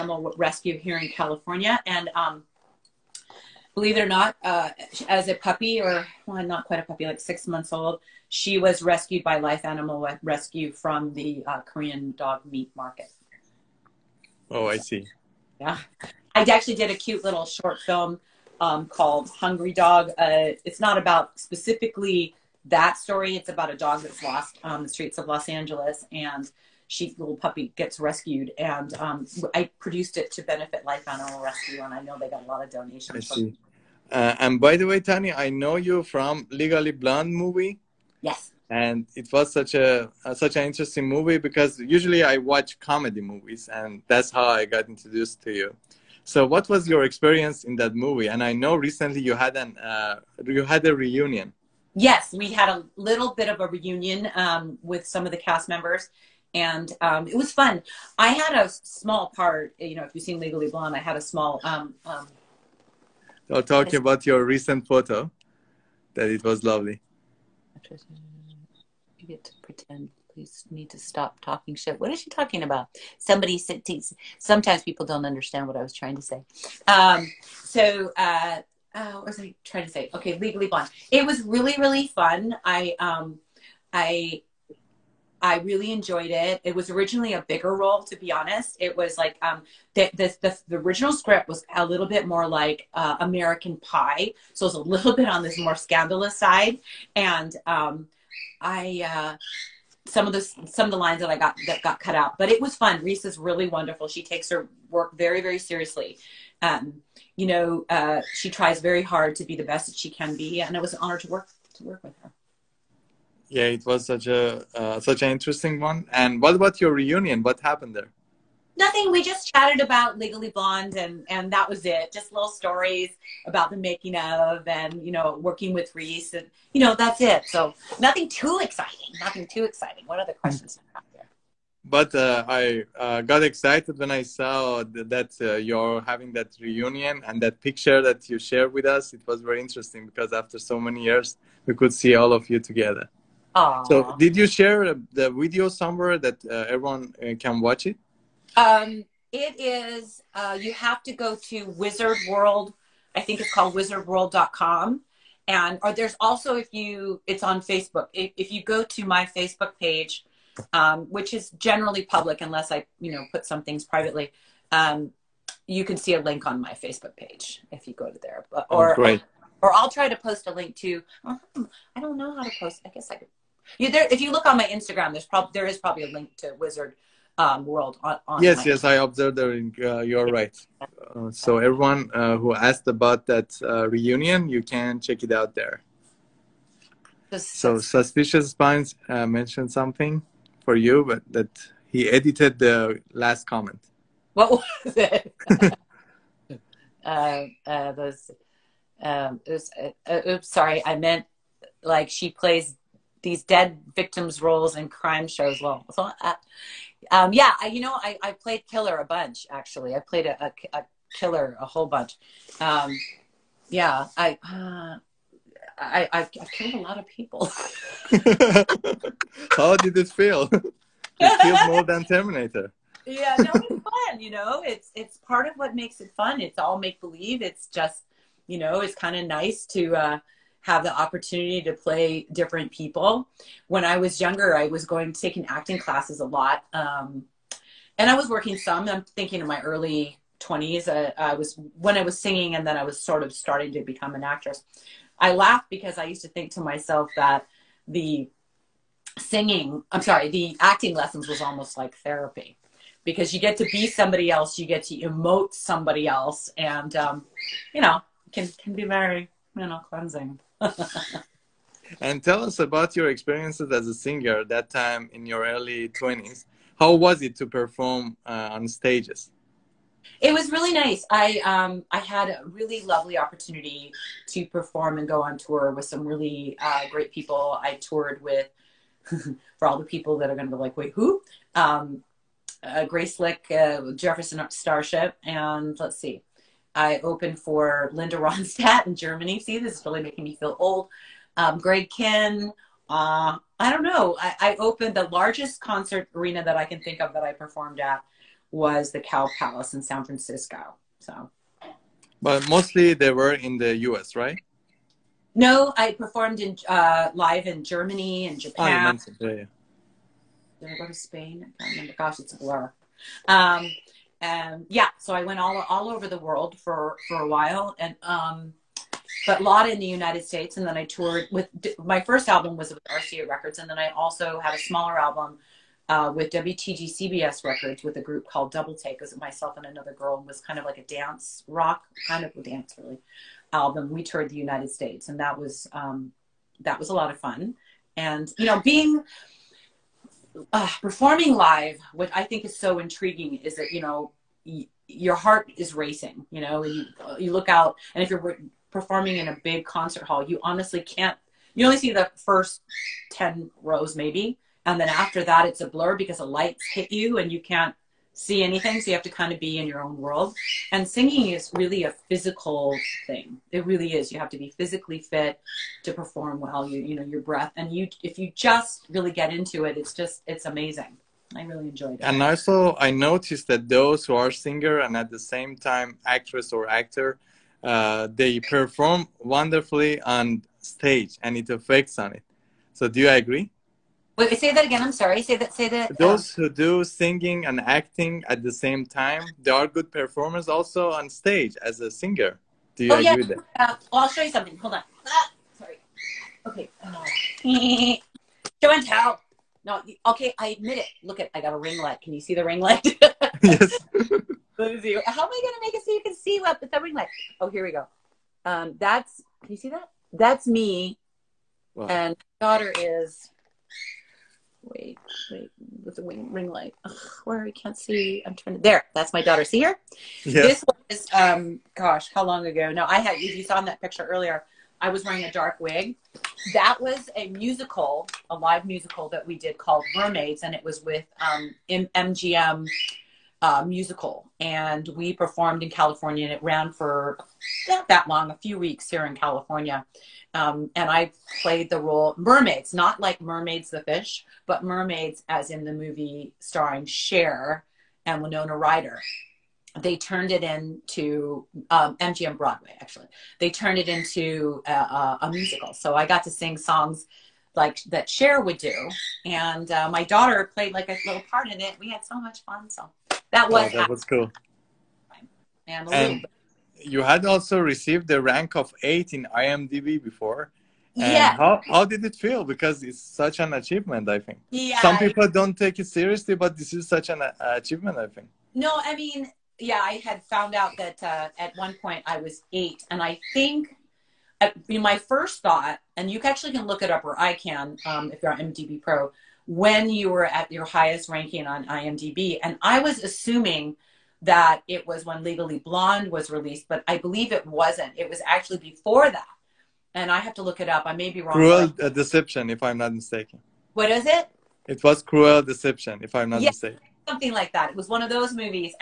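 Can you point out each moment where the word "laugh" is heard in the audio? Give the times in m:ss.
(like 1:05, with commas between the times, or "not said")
4:05.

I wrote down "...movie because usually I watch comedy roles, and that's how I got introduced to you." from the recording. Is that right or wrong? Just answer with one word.
wrong.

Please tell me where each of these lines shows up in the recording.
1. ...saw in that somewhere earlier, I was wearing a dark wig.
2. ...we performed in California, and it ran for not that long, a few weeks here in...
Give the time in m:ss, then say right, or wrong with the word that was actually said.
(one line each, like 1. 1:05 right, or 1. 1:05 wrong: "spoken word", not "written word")
1. 7:03 wrong: "picture", not "somewhere"
2. 7:14 right.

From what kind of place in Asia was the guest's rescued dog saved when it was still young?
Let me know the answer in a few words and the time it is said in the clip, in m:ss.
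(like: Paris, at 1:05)
Korean dog meat market, at 0:11.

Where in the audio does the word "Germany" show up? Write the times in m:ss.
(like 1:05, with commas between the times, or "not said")
4:48, 5:07.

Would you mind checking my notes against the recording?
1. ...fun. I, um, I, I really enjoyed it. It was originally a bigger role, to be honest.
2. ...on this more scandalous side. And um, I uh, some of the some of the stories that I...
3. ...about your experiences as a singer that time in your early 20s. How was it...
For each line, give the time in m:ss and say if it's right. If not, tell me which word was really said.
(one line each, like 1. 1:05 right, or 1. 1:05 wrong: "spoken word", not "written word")
1. 1:22 right
2. 1:35 wrong: "lines", not "stories"
3. 4:22 right.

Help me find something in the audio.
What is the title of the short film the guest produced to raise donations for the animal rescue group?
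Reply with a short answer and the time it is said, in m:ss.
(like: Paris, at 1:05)
Hungry Dog, at 0:19.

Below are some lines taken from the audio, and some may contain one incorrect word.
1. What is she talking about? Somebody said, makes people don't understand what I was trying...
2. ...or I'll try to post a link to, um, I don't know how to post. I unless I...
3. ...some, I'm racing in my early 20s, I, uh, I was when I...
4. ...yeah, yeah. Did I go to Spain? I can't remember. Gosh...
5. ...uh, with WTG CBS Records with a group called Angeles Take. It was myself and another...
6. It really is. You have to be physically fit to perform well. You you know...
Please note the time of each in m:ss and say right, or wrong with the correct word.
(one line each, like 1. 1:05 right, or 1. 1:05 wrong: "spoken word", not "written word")
1. 1:11 wrong: "sometimes", not "makes"
2. 2:49 wrong: "guess", not "unless"
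3. 3:58 wrong: "thinking", not "racing"
4. 5:09 right
5. 5:25 wrong: "Double", not "Angeles"
6. 6:03 right.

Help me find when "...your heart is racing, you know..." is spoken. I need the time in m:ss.
5:44.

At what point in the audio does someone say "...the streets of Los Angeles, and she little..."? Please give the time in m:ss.
0:24.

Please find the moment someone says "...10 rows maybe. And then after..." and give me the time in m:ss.
5:53.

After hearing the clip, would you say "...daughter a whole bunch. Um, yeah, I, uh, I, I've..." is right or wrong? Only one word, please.
wrong.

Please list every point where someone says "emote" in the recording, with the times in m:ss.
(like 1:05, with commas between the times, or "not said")
4:14.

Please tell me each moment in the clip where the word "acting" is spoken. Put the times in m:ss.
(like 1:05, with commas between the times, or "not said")
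3:55, 4:10, 6:27.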